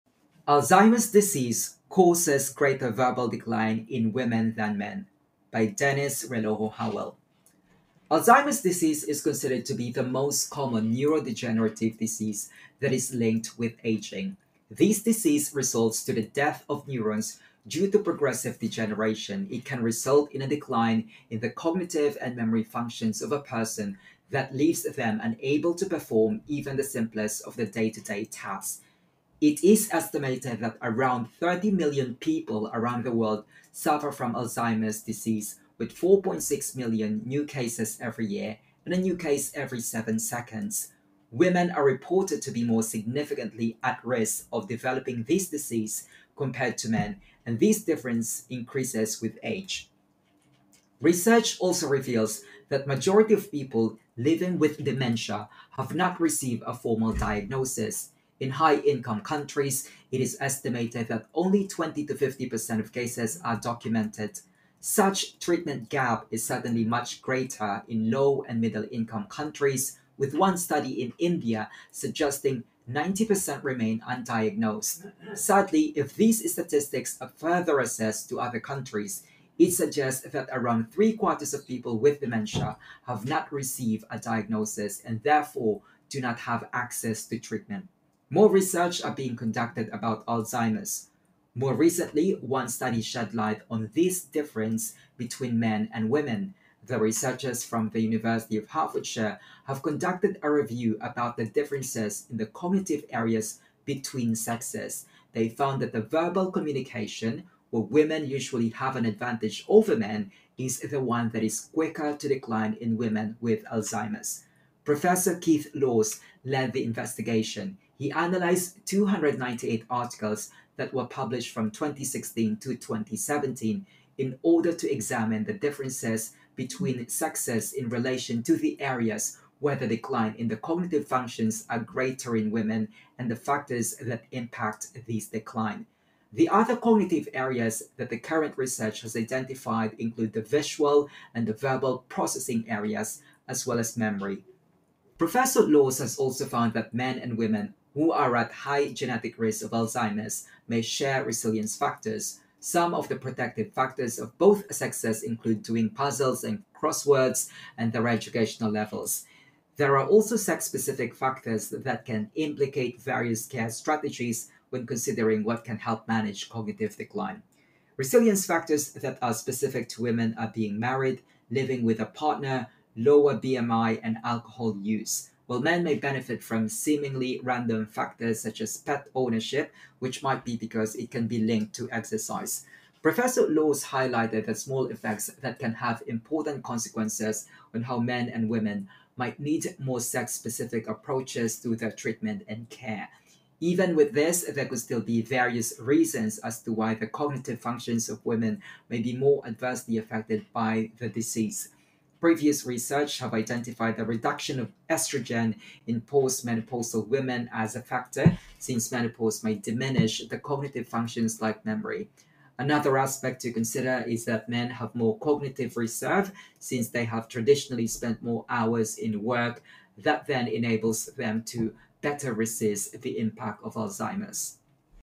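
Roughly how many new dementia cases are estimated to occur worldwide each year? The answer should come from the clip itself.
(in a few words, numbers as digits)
4.6 million.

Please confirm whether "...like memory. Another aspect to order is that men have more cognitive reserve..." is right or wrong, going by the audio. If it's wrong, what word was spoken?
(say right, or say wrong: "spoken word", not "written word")
wrong: "consider", not "order".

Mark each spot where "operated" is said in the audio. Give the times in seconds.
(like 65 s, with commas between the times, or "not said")
not said.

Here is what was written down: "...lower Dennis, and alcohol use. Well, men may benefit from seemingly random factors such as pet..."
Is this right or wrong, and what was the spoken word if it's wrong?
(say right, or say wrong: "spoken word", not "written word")
wrong: "BMI", not "Dennis".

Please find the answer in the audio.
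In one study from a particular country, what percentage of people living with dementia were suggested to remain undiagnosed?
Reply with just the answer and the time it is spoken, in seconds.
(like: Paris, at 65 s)
90%, at 72 s.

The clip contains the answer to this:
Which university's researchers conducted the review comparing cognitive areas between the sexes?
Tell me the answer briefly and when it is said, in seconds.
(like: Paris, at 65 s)
University of Hertfordshire, at 97 s.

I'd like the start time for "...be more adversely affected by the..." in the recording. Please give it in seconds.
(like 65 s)
199 s.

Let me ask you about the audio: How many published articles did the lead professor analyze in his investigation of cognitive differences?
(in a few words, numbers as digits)
298.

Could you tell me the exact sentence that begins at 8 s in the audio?
Alzheimer's disease is considered to be the most common neurodegenerative disease that is linked with aging.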